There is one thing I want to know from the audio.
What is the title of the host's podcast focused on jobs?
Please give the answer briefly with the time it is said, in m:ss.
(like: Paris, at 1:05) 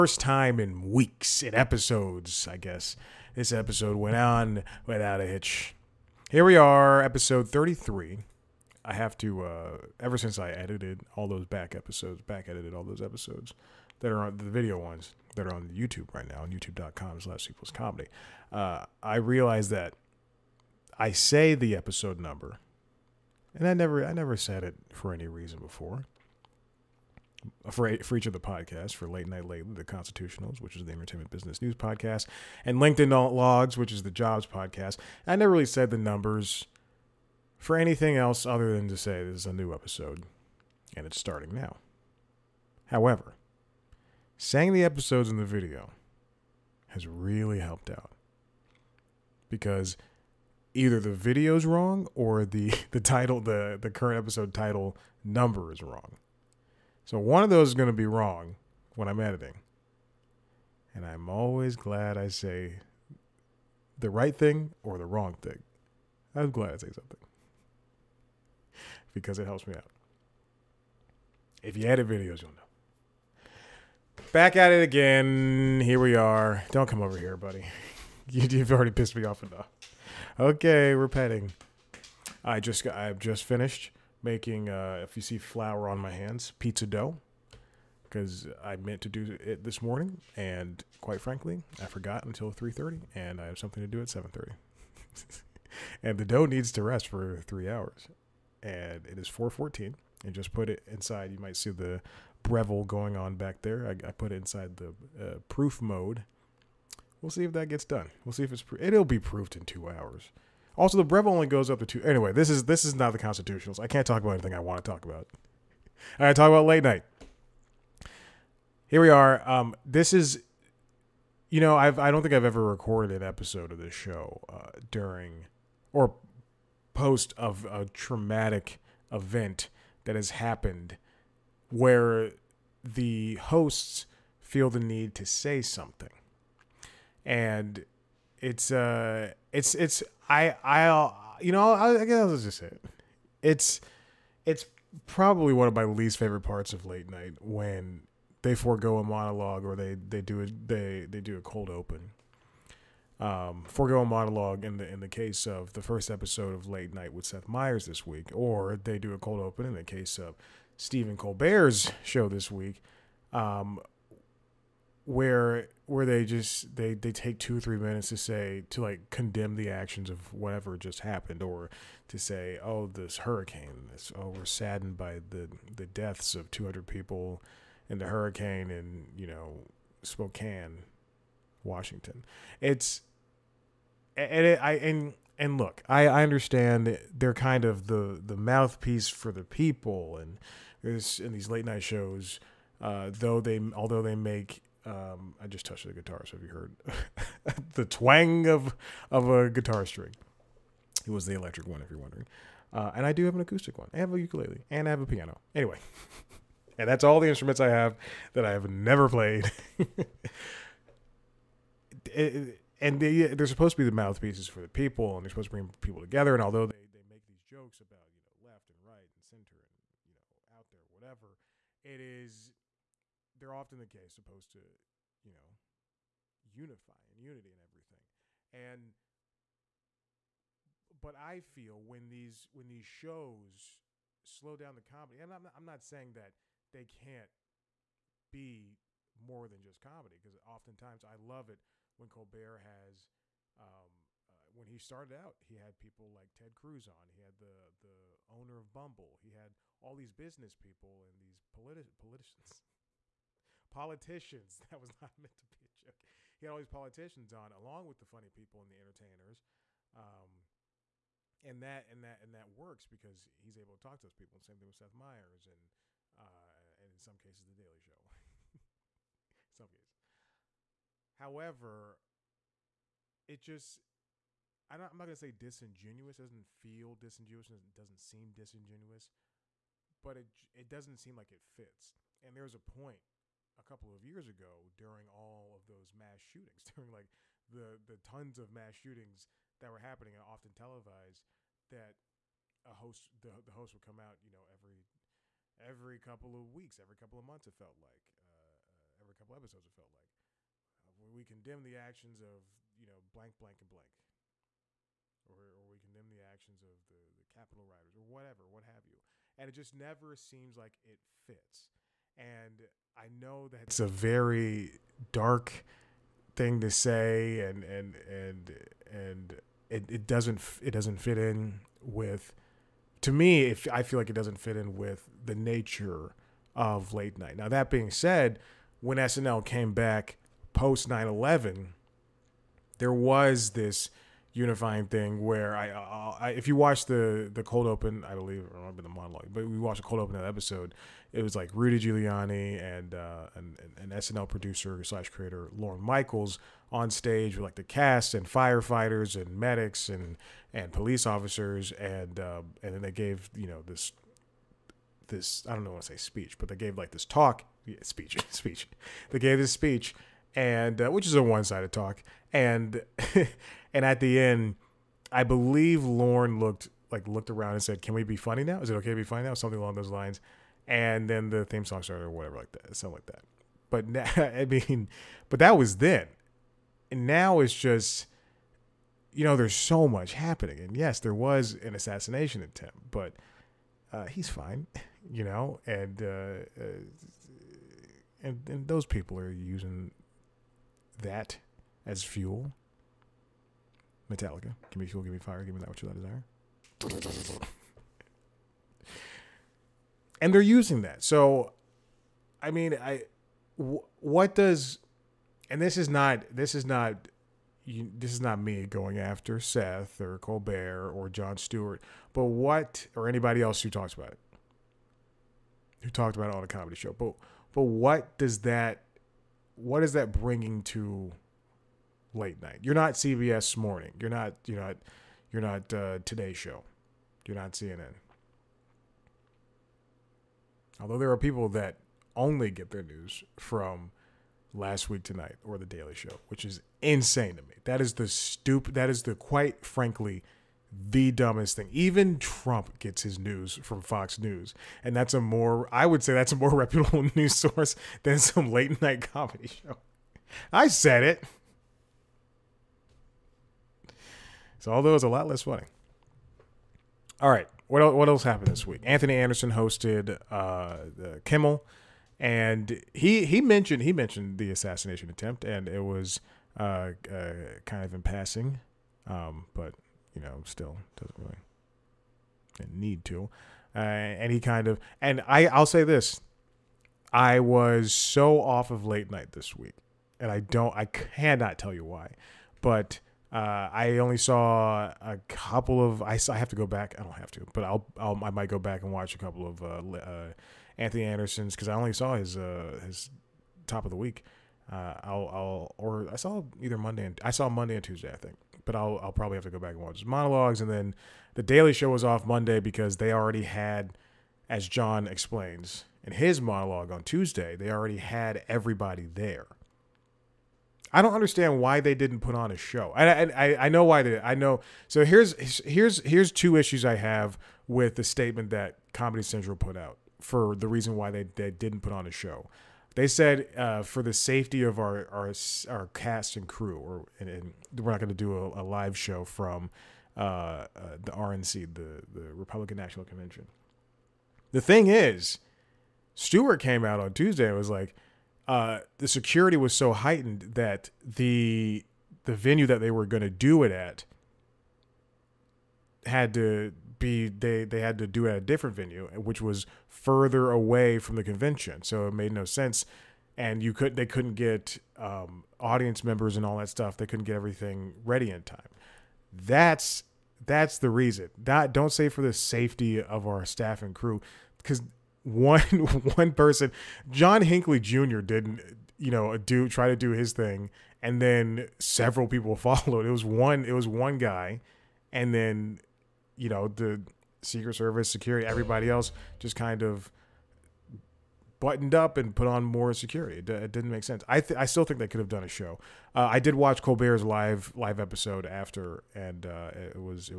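LinkedIn Logs, at 0:32.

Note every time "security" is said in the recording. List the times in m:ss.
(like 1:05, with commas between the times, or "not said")
8:59, 9:38, 9:42.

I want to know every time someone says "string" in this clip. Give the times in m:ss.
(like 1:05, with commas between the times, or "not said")
3:19.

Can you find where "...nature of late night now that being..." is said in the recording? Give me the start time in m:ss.
5:25.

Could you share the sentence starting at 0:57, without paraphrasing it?
So one of those is going to be wrong when I'm editing.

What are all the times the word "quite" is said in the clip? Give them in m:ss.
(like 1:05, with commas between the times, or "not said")
1:31, 7:19.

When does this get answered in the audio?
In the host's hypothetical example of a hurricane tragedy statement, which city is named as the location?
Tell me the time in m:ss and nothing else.
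3:00.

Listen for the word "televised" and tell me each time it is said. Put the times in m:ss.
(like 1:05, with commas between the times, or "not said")
4:50.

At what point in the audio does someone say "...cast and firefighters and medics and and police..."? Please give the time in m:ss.
5:47.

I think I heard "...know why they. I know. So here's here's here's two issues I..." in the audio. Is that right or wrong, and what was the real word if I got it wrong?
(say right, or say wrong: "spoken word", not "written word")
right.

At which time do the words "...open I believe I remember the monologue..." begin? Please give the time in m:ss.
5:37.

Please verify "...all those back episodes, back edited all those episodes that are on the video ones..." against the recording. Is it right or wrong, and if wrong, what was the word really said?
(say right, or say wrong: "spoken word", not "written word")
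right.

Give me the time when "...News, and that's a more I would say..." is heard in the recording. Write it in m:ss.
7:24.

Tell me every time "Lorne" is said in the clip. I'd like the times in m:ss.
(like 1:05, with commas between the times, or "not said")
5:45, 6:05.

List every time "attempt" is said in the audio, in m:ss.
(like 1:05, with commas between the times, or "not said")
6:22, 7:45.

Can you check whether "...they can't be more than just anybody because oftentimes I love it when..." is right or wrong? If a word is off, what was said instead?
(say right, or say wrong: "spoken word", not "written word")
wrong: "comedy", not "anybody".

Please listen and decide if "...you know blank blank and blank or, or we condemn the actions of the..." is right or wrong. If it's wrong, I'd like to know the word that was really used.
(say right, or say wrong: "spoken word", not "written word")
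right.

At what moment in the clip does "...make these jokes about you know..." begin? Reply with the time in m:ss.
3:37.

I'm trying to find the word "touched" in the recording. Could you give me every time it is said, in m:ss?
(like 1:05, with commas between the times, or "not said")
3:15.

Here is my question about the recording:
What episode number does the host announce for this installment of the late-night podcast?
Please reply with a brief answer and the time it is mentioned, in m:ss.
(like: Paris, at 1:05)
33, at 0:07.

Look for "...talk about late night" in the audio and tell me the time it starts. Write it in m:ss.
1:56.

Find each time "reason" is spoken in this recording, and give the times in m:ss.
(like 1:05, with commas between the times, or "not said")
0:25, 8:40, 9:20.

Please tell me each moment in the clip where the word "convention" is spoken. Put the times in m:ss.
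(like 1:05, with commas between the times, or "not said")
8:53, 9:11.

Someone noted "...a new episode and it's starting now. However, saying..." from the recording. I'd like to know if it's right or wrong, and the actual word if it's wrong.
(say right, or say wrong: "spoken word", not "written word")
right.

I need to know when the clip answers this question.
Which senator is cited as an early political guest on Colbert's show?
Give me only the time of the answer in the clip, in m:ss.
4:06.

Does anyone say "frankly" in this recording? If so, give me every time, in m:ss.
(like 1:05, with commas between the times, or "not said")
1:31, 7:19.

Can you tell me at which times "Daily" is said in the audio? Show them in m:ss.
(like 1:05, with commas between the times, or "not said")
4:27, 7:15, 8:21.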